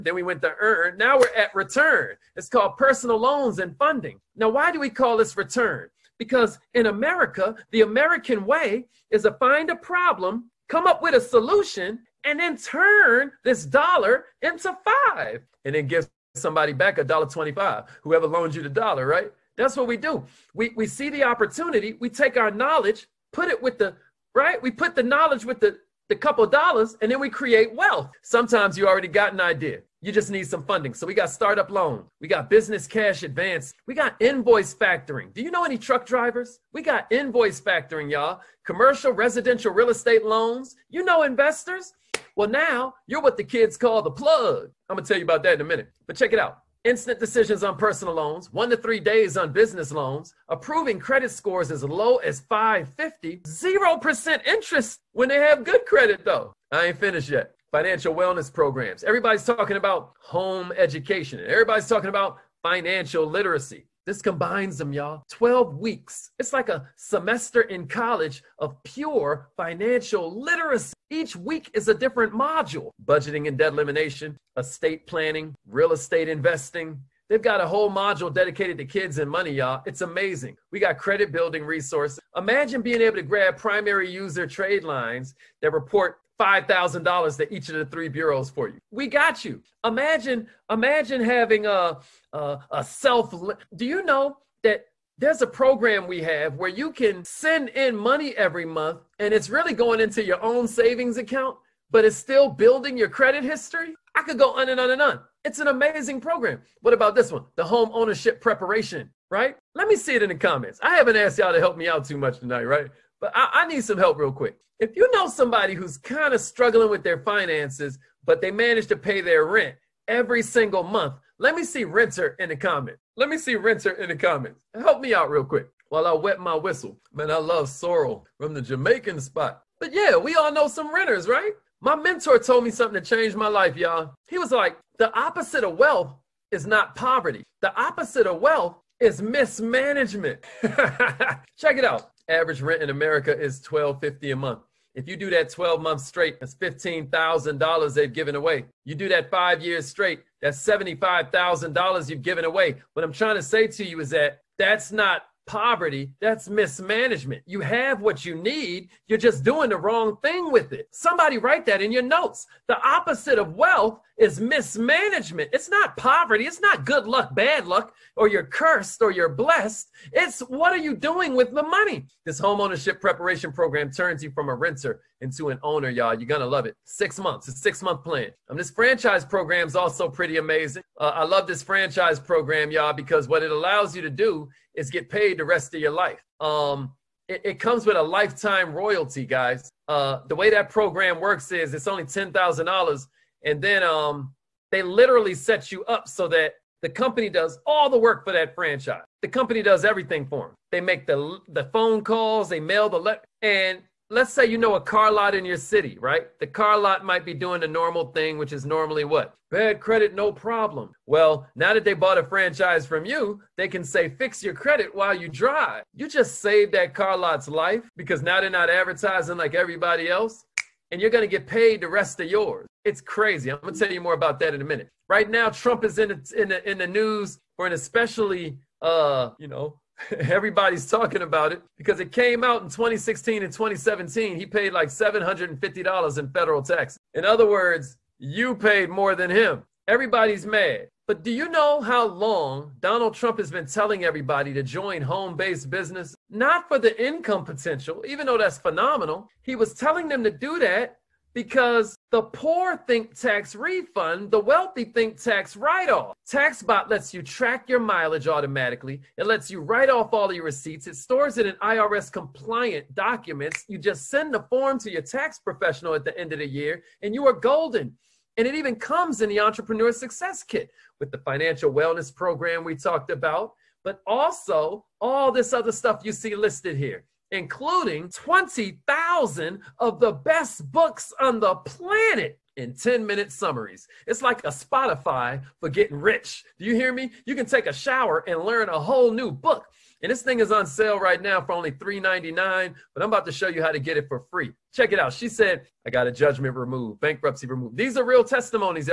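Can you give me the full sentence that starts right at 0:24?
We put the knowledge with the, the couple dollars, and then we create wealth.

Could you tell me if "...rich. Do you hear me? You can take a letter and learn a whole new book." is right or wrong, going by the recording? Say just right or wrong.
wrong.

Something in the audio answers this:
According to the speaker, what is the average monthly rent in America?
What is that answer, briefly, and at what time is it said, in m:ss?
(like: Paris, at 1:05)
$1,250, at 2:23.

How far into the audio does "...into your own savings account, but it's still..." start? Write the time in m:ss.
1:39.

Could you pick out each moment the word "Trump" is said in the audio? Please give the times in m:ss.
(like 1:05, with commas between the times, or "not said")
3:45, 4:03.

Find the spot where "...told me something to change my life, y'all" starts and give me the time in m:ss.
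2:12.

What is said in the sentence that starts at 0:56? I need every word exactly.
I ain't finished yet financial wellness programs.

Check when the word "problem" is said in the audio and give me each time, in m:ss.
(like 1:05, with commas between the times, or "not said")
0:09, 3:30.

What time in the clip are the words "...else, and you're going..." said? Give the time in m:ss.
3:40.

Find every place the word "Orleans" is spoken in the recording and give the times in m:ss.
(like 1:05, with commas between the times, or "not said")
not said.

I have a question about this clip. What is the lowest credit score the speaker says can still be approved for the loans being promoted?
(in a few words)
550.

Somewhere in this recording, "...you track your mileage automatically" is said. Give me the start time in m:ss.
4:17.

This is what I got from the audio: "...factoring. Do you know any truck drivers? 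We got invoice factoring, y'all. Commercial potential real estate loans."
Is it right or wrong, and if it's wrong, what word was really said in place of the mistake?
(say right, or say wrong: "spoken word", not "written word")
wrong: "residential", not "potential".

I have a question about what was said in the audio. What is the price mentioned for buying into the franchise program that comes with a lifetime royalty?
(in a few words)
$10,000.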